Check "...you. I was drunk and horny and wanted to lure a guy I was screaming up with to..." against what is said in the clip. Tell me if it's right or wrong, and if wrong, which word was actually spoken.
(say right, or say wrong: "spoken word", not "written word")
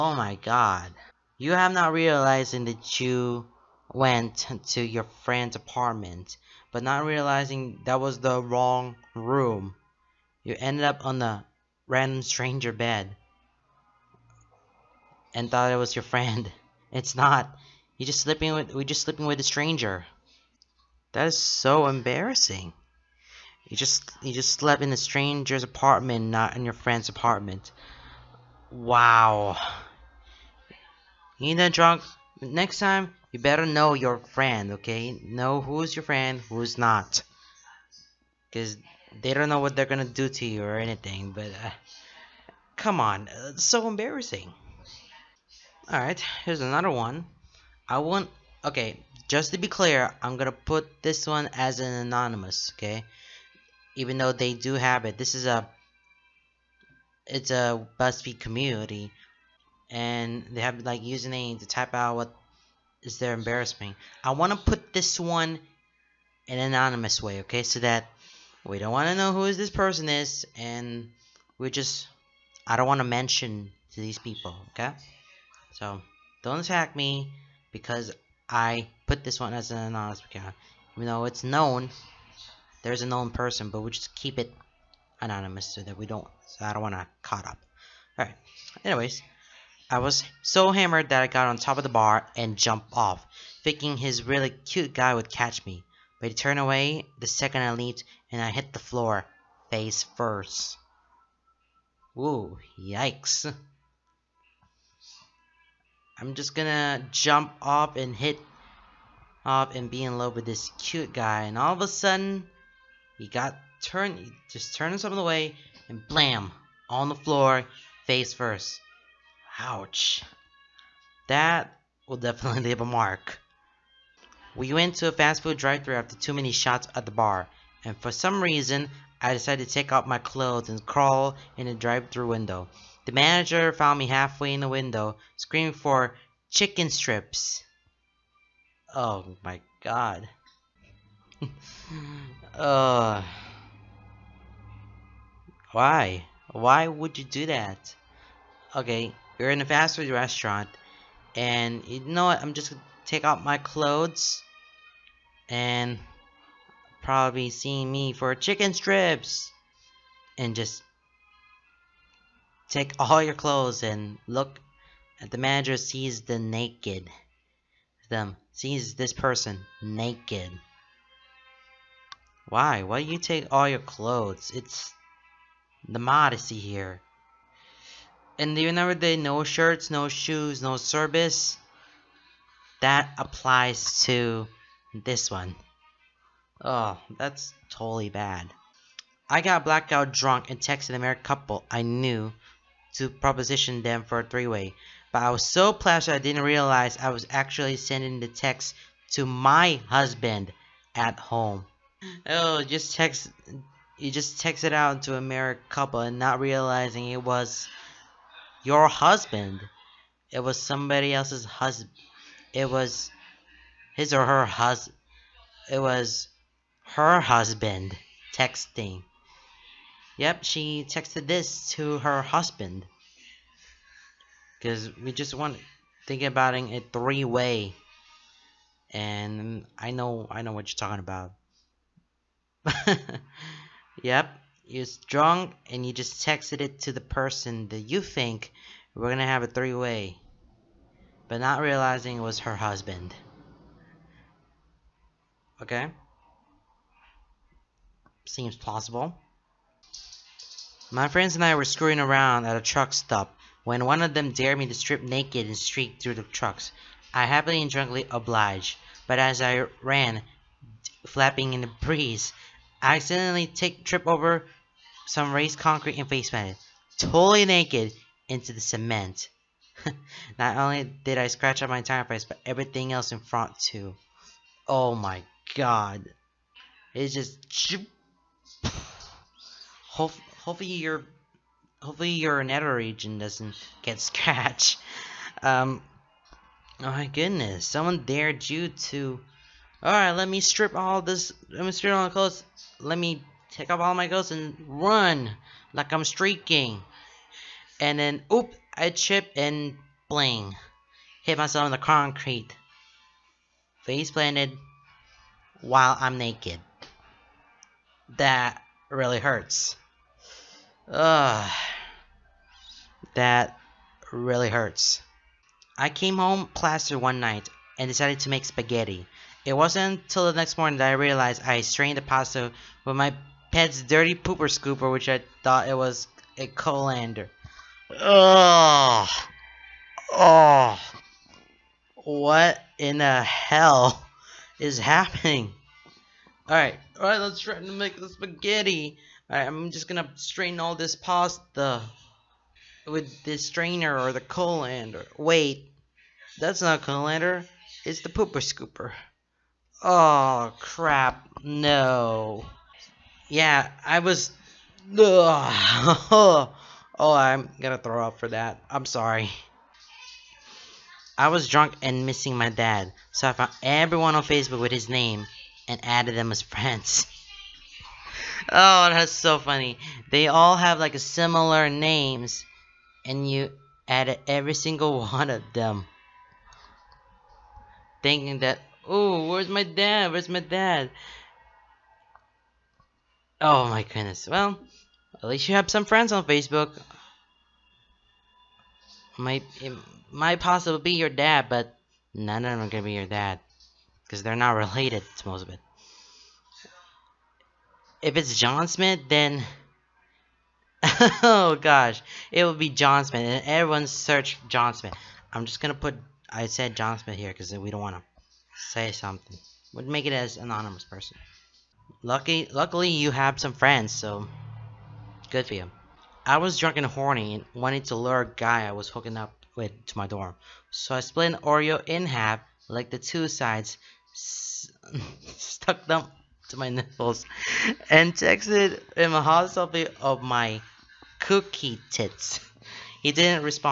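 wrong: "hooking", not "screaming".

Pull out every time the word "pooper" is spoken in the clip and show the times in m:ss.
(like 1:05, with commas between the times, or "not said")
5:24, 5:48.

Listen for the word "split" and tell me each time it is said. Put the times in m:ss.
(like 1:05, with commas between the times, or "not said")
7:00.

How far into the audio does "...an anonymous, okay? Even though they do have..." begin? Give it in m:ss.
0:51.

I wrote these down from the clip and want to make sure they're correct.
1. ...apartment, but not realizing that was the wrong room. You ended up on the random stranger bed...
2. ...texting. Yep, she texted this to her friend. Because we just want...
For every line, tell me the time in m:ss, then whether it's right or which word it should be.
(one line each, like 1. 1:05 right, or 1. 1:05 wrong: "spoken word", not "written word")
1. 0:05 right
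2. 3:38 wrong: "husband", not "friend".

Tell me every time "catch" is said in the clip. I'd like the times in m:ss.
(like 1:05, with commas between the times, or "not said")
1:35.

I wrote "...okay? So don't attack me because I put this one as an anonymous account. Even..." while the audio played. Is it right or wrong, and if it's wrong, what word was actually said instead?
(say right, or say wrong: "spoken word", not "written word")
right.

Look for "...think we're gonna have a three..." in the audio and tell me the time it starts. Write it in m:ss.
3:58.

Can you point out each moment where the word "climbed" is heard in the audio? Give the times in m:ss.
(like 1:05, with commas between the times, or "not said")
not said.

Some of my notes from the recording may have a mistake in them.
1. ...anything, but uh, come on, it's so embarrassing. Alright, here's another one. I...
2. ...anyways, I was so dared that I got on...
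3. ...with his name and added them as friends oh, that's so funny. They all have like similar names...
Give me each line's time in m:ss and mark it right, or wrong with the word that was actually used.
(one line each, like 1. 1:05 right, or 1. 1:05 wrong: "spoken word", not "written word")
1. 0:40 right
2. 1:28 wrong: "hammered", not "dared"
3. 6:04 right.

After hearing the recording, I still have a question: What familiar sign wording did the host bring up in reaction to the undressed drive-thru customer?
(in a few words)
No shirts, no shoes, no service.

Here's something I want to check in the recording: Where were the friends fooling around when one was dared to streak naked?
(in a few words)
A truck stop.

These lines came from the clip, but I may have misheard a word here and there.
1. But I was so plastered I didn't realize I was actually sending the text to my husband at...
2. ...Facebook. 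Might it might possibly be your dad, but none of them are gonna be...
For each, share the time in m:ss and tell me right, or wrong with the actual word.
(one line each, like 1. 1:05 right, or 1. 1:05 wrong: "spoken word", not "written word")
1. 3:15 right
2. 6:26 right.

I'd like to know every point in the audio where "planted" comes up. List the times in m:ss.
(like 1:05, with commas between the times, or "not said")
4:26, 5:04.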